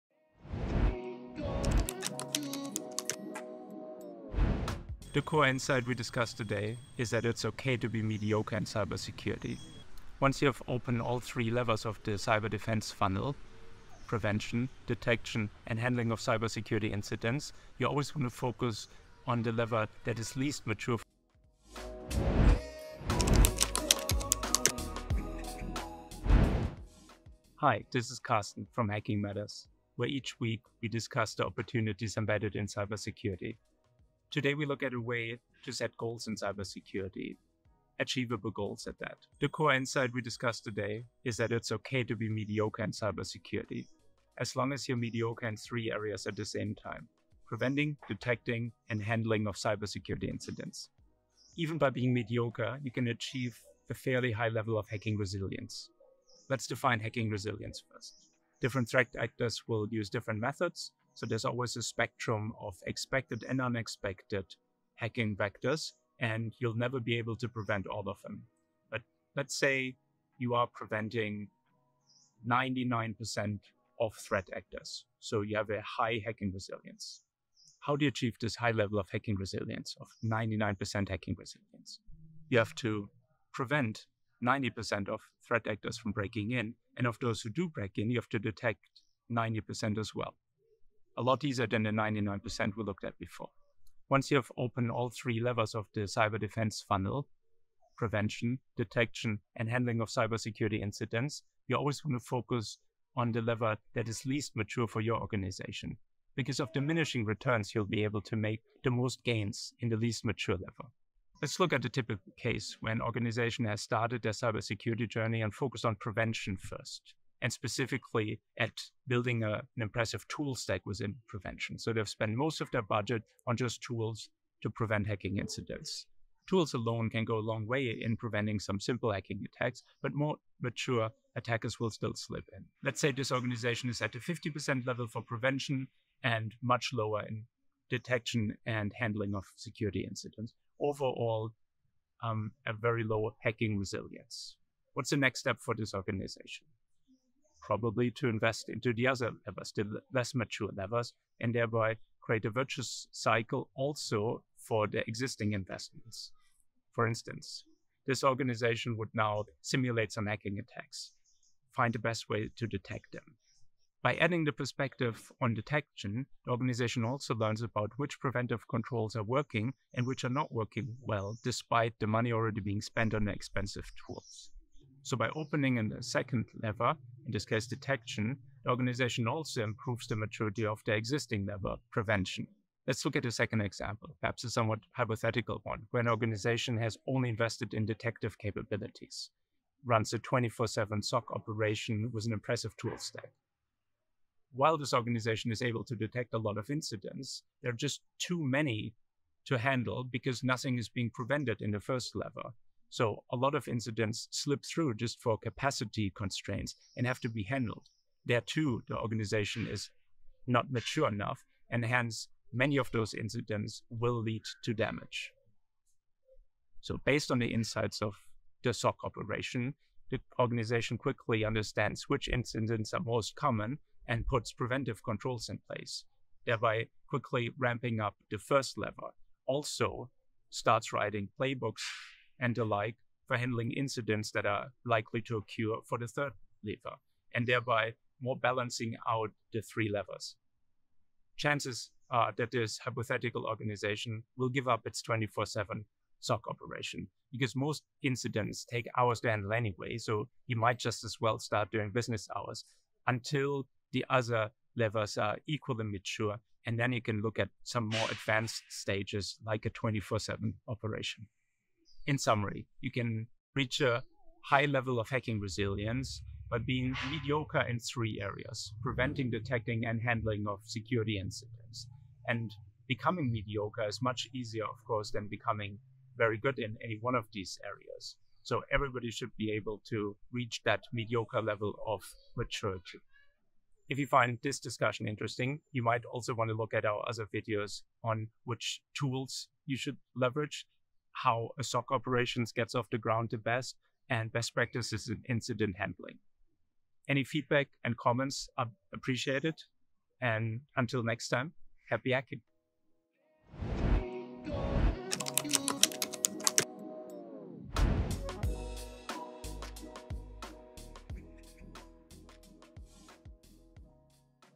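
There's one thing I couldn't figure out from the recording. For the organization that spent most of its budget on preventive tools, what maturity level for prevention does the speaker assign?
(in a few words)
50%.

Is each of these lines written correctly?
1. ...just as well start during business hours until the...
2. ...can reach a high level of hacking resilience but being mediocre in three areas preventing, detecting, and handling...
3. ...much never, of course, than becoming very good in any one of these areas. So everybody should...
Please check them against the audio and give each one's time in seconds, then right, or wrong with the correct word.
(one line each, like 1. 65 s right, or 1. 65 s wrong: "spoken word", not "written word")
1. 250 s right
2. 262 s right
3. 274 s wrong: "easier", not "never".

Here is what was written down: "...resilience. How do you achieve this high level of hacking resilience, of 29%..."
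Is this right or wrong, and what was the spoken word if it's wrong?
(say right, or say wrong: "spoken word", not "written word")
wrong: "99", not "29".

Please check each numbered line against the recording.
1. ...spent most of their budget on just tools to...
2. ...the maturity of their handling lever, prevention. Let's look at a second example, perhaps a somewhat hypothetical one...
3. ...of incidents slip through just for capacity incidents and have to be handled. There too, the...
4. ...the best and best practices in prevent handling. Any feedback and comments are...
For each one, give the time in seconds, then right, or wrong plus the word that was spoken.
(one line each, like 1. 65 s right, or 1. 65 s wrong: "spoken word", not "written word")
1. 122 s right
2. 180 s wrong: "existing", not "handling"
3. 203 s wrong: "constraints", not "incidents"
4. 293 s wrong: "incident", not "prevent".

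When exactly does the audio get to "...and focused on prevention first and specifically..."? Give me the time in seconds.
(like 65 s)
115 s.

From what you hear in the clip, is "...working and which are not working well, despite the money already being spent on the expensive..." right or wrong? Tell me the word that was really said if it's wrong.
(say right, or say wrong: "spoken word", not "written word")
right.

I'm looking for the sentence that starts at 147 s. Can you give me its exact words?
probably to invest into the other levers, the less mature levers, and thereby create a virtuous cycle also for the existing investments.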